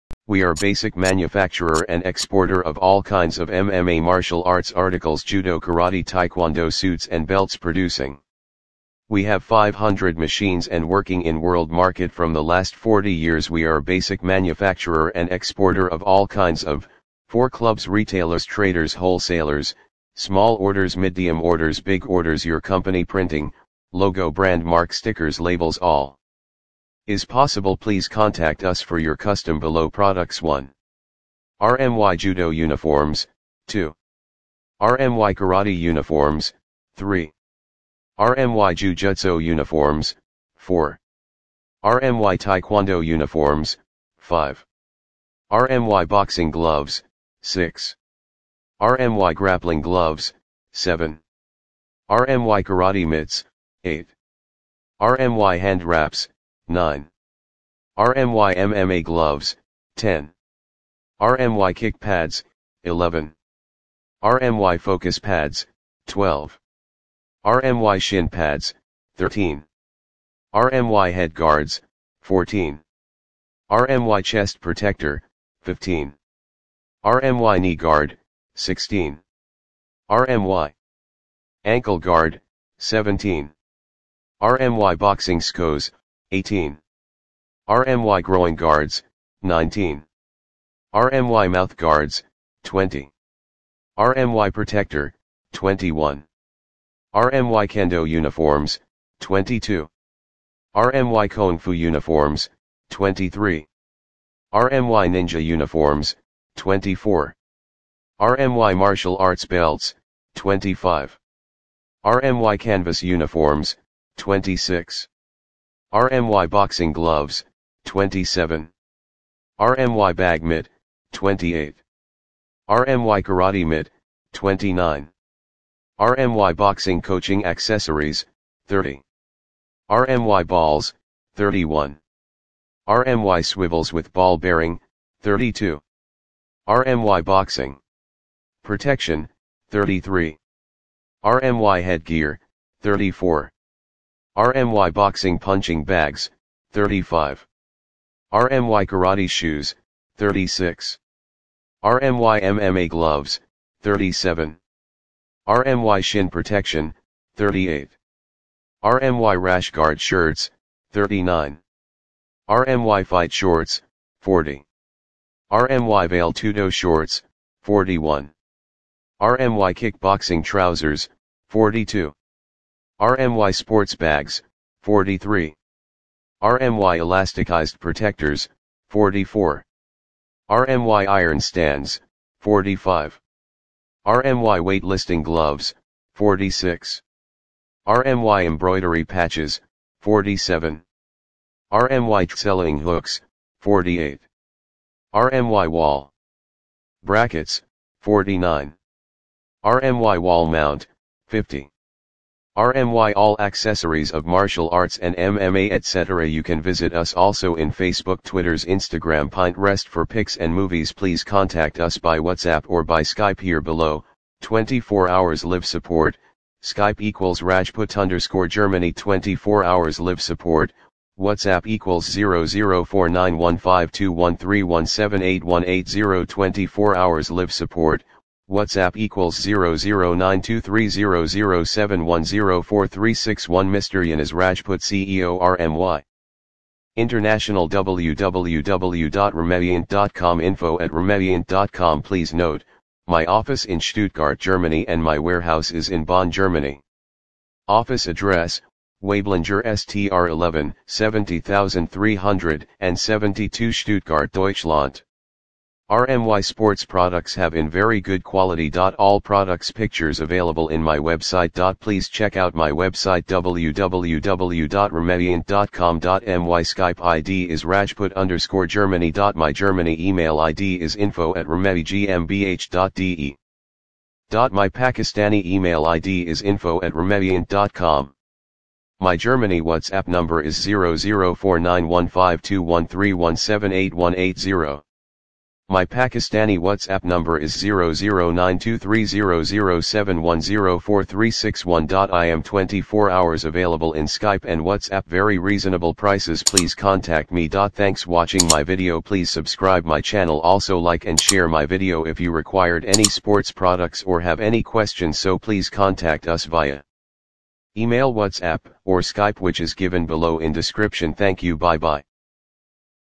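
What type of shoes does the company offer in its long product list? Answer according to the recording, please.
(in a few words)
karate shoes.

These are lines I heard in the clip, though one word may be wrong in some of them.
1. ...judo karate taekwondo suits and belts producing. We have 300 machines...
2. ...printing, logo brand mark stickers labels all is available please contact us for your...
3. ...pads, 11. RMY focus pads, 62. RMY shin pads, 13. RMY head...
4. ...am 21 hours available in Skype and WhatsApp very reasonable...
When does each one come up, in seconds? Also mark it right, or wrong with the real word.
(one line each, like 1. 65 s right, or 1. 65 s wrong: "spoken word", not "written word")
1. 5 s wrong: "500", not "300"
2. 23 s wrong: "possible", not "available"
3. 61 s wrong: "12", not "62"
4. 292 s wrong: "24", not "21".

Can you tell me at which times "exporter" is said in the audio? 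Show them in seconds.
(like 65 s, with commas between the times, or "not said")
2 s, 15 s.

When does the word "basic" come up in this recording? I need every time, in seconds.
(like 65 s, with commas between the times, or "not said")
0 s, 13 s.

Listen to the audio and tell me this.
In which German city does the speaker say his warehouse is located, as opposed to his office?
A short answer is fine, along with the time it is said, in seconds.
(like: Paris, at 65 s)
Bonn, at 246 s.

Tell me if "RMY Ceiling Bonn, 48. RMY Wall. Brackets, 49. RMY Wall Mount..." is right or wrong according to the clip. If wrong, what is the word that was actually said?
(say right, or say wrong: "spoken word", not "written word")
wrong: "Hooks", not "Bonn".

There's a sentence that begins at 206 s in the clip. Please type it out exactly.
You can visit us also in Facebook, Twitter's Instagram, Pinterest for pics and movies.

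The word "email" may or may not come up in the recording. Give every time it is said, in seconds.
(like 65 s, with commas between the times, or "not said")
269 s, 275 s, 307 s.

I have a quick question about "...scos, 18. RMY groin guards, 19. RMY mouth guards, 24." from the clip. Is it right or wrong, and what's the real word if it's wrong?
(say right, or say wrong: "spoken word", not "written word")
wrong: "20", not "24".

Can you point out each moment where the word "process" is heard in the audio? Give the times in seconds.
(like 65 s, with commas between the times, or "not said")
not said.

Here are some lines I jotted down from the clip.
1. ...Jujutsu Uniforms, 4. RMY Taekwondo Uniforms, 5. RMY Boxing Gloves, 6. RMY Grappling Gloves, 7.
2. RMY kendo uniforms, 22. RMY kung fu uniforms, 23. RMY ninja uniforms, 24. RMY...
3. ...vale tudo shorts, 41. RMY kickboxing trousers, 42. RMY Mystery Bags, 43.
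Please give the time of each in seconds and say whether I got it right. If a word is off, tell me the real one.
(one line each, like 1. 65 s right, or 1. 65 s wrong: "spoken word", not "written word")
1. 38 s right
2. 97 s right
3. 166 s wrong: "Sports", not "Mystery".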